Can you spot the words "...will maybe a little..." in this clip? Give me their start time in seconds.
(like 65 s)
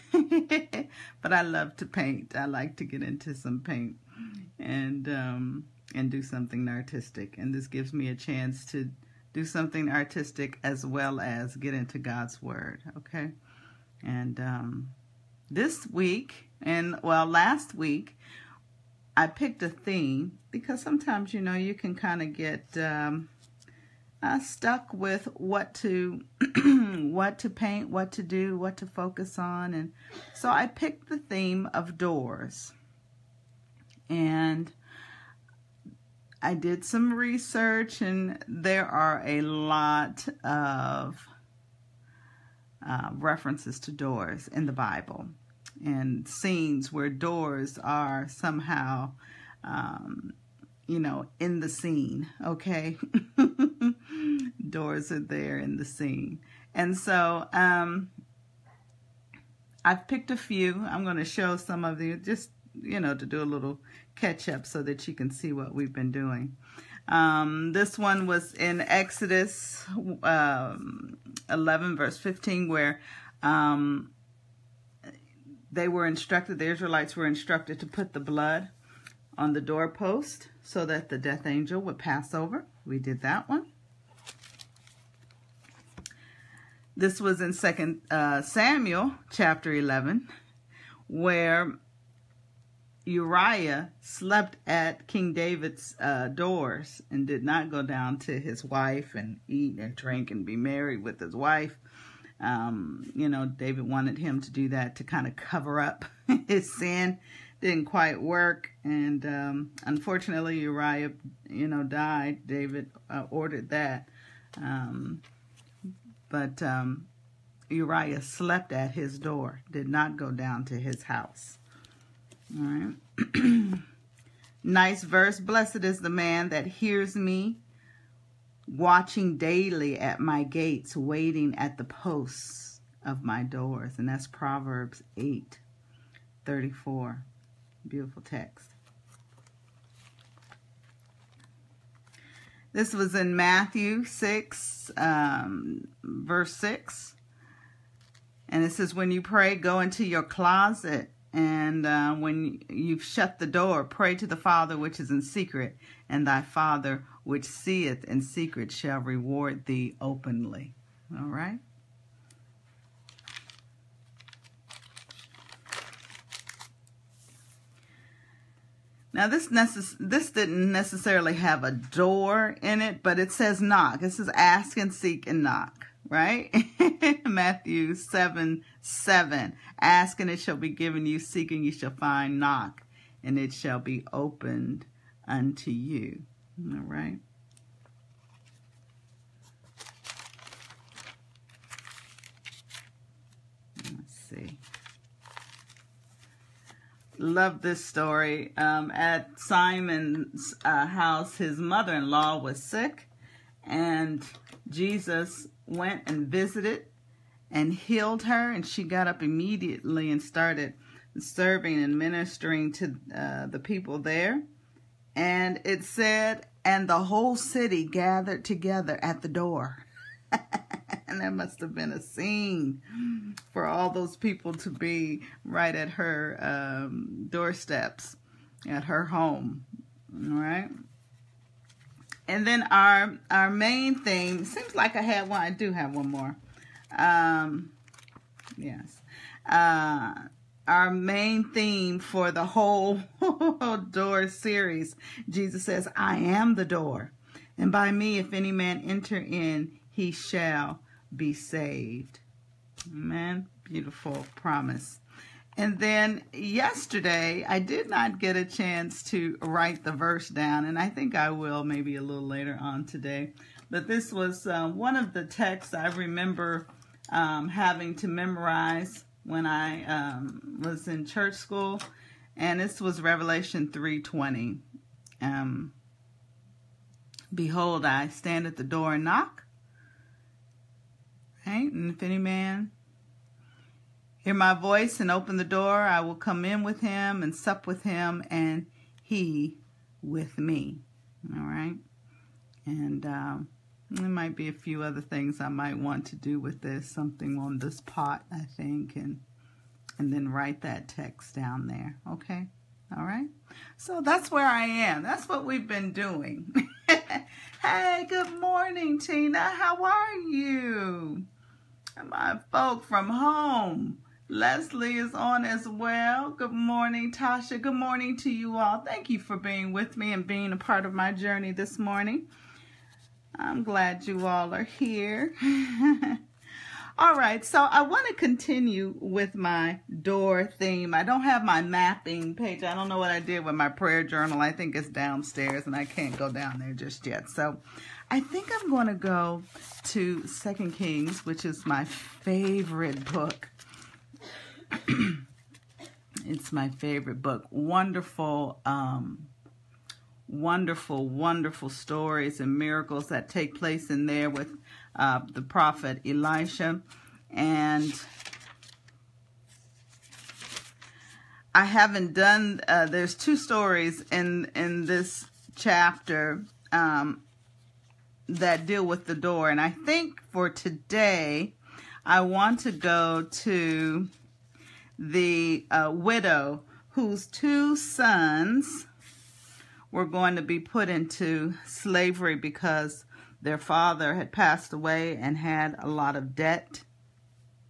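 261 s.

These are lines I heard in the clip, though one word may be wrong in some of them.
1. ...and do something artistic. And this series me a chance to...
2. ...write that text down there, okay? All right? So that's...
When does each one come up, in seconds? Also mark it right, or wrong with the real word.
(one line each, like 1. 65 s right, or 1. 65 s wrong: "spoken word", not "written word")
1. 5 s wrong: "gives", not "series"
2. 300 s right.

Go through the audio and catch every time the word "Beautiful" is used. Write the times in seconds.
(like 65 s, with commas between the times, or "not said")
137 s, 253 s.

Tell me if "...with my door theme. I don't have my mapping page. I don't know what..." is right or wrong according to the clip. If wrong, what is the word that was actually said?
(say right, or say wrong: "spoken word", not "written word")
right.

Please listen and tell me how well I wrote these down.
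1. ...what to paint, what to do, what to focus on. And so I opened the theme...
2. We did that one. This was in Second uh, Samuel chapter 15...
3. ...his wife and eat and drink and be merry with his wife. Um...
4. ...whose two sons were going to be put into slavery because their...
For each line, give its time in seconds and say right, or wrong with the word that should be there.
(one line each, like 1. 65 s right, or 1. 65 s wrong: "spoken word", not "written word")
1. 27 s wrong: "picked", not "opened"
2. 82 s wrong: "11", not "15"
3. 98 s right
4. 376 s right.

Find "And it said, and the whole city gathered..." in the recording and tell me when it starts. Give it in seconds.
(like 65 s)
215 s.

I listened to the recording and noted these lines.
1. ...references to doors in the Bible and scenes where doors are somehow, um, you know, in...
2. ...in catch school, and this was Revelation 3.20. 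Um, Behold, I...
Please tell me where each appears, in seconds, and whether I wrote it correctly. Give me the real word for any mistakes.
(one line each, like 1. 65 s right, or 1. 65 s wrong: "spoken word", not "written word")
1. 43 s right
2. 270 s wrong: "church", not "catch".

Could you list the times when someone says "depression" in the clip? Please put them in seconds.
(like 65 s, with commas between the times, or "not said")
not said.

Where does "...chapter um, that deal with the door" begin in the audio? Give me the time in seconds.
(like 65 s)
365 s.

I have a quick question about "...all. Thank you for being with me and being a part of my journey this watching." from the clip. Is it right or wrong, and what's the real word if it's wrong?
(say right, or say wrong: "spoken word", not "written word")
wrong: "morning", not "watching".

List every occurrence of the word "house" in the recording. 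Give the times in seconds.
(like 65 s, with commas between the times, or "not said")
121 s, 200 s.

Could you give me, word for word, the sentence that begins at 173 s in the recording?
This is ask and seek and knock, right?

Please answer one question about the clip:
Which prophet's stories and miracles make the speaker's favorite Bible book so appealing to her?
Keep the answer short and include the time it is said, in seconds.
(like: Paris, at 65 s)
Elisha, at 356 s.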